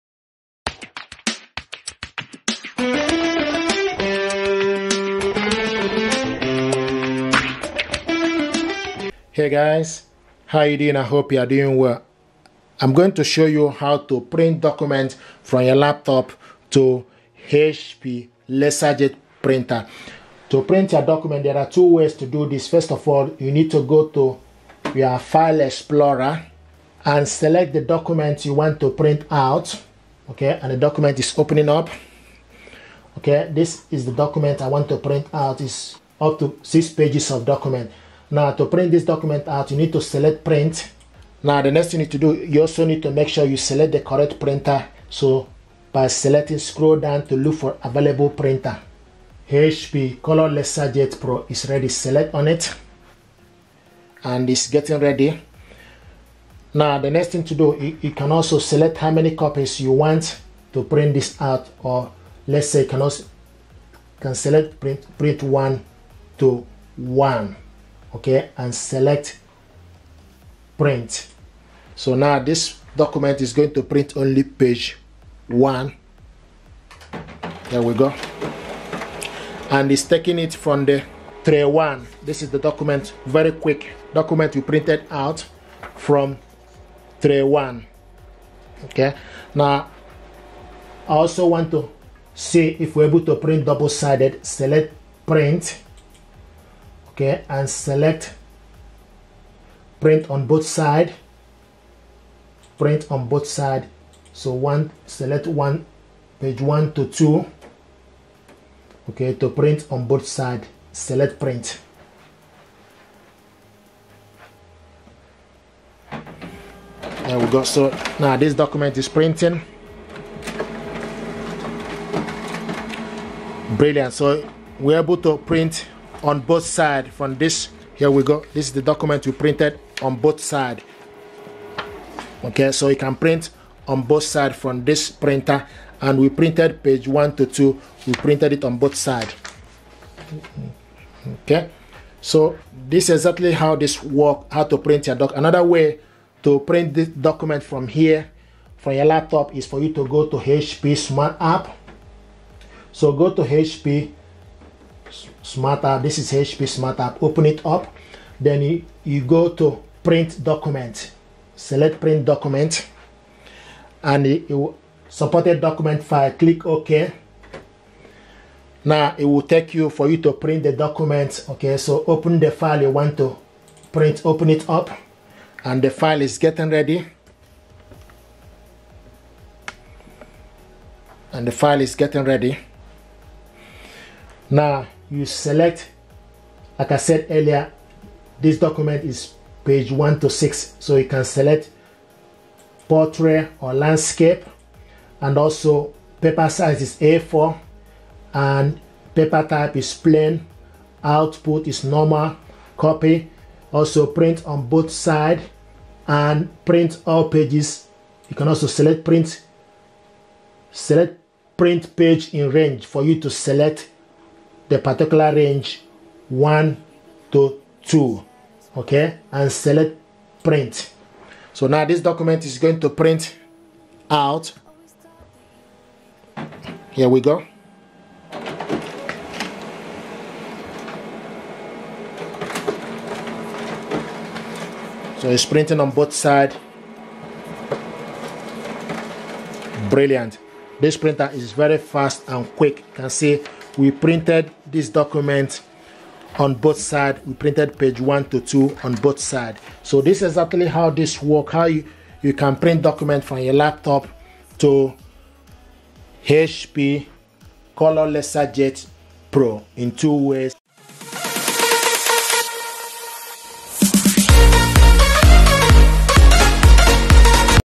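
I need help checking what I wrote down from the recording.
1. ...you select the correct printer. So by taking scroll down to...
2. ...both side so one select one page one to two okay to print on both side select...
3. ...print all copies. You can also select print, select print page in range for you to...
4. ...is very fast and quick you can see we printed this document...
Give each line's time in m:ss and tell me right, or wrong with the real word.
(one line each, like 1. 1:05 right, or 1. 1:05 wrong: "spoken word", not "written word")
1. 0:43 wrong: "selecting", not "taking"
2. 1:43 right
3. 3:26 wrong: "pages", not "copies"
4. 4:01 right.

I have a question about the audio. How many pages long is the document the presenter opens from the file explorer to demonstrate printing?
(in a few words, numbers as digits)
6.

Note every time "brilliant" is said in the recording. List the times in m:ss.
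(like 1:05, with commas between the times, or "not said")
2:03, 3:59.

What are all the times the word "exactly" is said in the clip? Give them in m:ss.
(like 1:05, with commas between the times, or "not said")
2:23, 4:10.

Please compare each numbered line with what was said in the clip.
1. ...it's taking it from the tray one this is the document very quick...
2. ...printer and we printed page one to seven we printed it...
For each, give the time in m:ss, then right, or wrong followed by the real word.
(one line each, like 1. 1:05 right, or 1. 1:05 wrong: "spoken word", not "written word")
1. 1:19 right
2. 2:15 wrong: "two", not "seven".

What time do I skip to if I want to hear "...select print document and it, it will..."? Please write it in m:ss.
2:41.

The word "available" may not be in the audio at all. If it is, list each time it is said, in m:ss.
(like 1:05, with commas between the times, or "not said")
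0:47.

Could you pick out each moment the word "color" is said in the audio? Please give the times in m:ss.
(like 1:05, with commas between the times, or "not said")
0:50, 4:17.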